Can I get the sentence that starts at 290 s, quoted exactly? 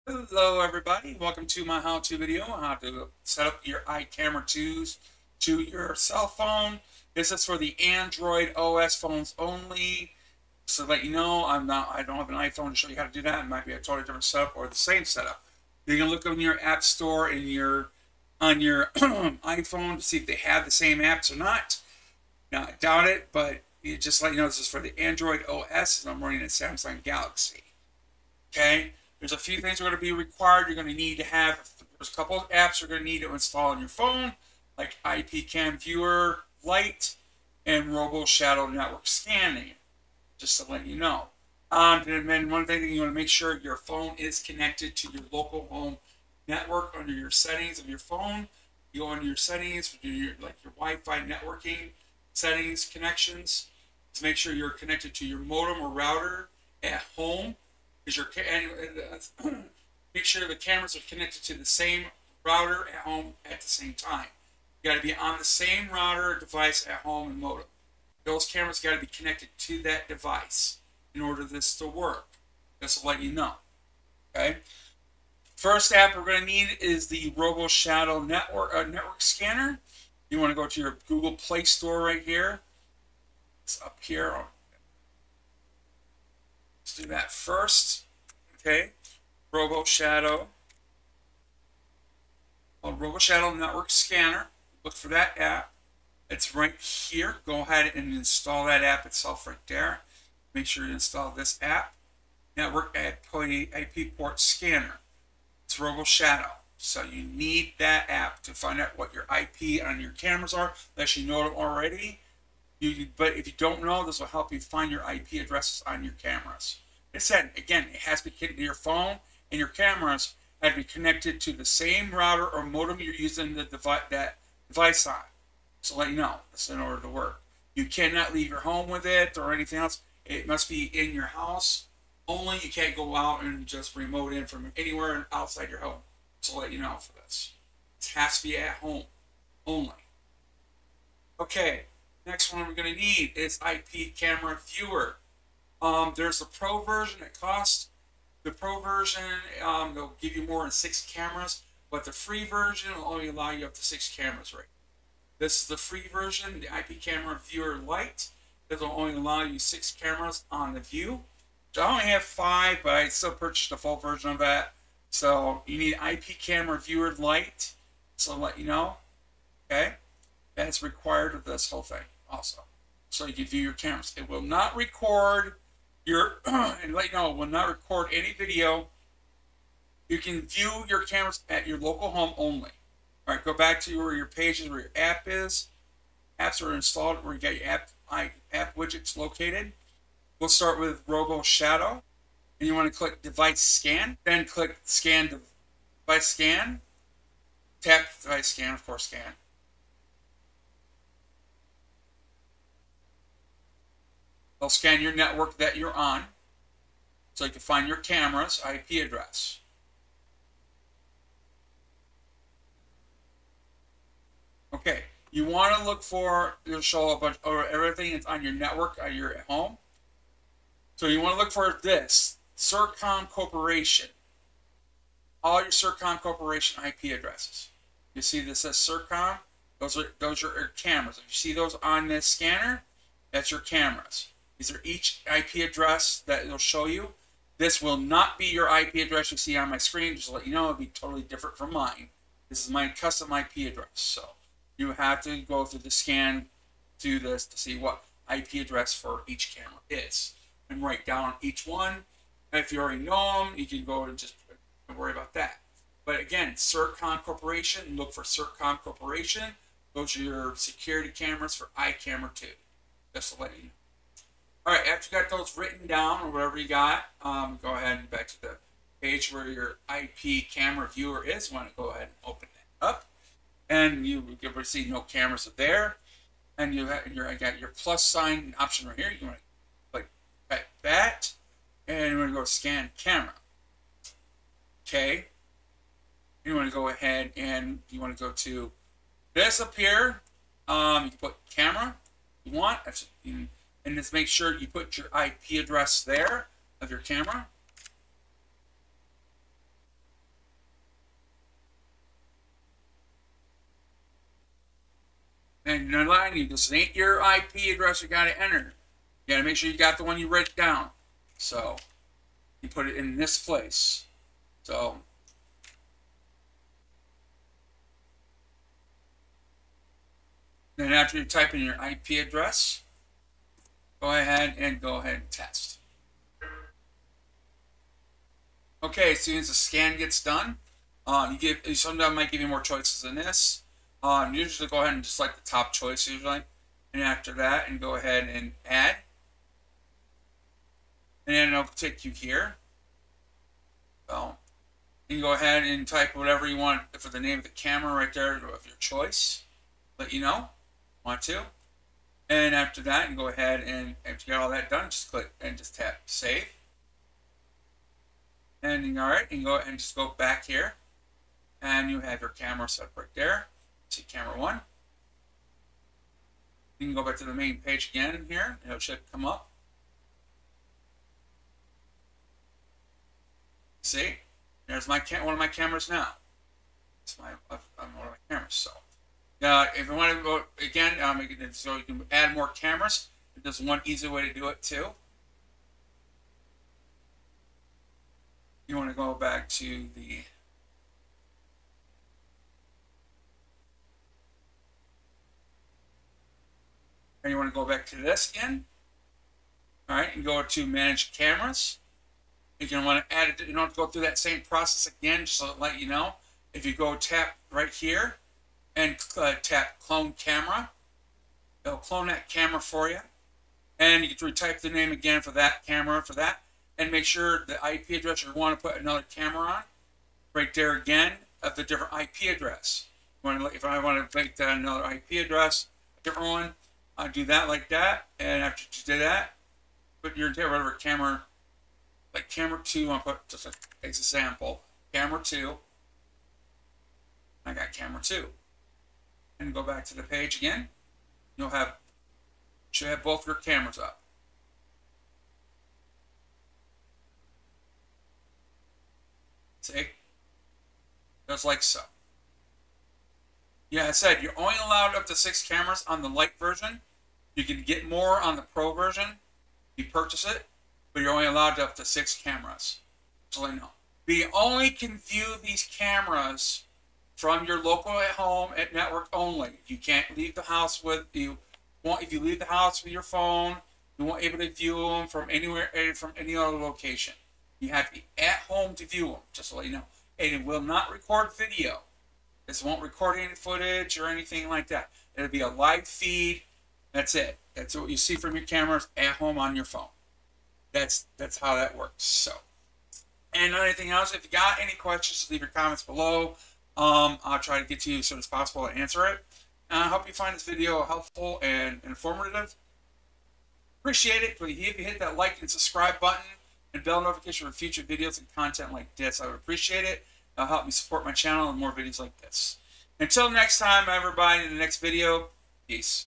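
Um, you can put camera you want.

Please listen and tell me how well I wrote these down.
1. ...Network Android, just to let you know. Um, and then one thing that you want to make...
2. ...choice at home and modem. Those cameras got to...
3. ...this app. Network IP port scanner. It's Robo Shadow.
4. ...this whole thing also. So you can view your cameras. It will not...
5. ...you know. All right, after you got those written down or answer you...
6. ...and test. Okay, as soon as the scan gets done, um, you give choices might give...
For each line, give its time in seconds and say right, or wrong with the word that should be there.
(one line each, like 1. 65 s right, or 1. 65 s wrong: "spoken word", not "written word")
1. 38 s wrong: "Scanning", not "Android"
2. 66 s wrong: "device", not "choice"
3. 101 s right
4. 171 s right
5. 263 s wrong: "whatever", not "answer"
6. 325 s wrong: "sometimes", not "choices".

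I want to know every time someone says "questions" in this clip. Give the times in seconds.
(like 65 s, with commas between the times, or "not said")
494 s.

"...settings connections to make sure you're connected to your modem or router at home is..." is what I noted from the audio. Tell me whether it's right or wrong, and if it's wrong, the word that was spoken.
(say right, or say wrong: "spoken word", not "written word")
right.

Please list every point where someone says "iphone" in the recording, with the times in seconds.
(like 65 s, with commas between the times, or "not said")
12 s, 18 s.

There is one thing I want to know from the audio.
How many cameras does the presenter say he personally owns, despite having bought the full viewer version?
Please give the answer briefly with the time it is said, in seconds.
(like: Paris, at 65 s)
5, at 162 s.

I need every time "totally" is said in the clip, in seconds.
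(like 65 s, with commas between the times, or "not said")
13 s, 240 s.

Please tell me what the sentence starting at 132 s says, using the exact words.
You can't go out and just remote in from anywhere outside your home.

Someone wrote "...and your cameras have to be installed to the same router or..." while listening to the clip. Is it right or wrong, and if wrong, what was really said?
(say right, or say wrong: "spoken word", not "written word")
wrong: "connected", not "installed".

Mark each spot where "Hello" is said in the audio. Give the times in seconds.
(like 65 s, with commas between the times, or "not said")
0 s.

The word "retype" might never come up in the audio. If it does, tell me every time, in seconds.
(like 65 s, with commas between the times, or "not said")
414 s.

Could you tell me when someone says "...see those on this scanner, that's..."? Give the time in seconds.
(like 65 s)
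231 s.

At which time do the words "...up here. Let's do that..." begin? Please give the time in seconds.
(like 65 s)
83 s.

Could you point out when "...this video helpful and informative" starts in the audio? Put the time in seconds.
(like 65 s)
500 s.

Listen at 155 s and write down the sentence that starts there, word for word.
This is the free version, the IP Camera Viewer Lite.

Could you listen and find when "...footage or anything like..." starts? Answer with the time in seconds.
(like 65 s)
483 s.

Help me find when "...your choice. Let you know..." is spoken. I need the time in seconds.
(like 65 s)
348 s.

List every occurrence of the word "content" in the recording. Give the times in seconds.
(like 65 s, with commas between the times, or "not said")
508 s.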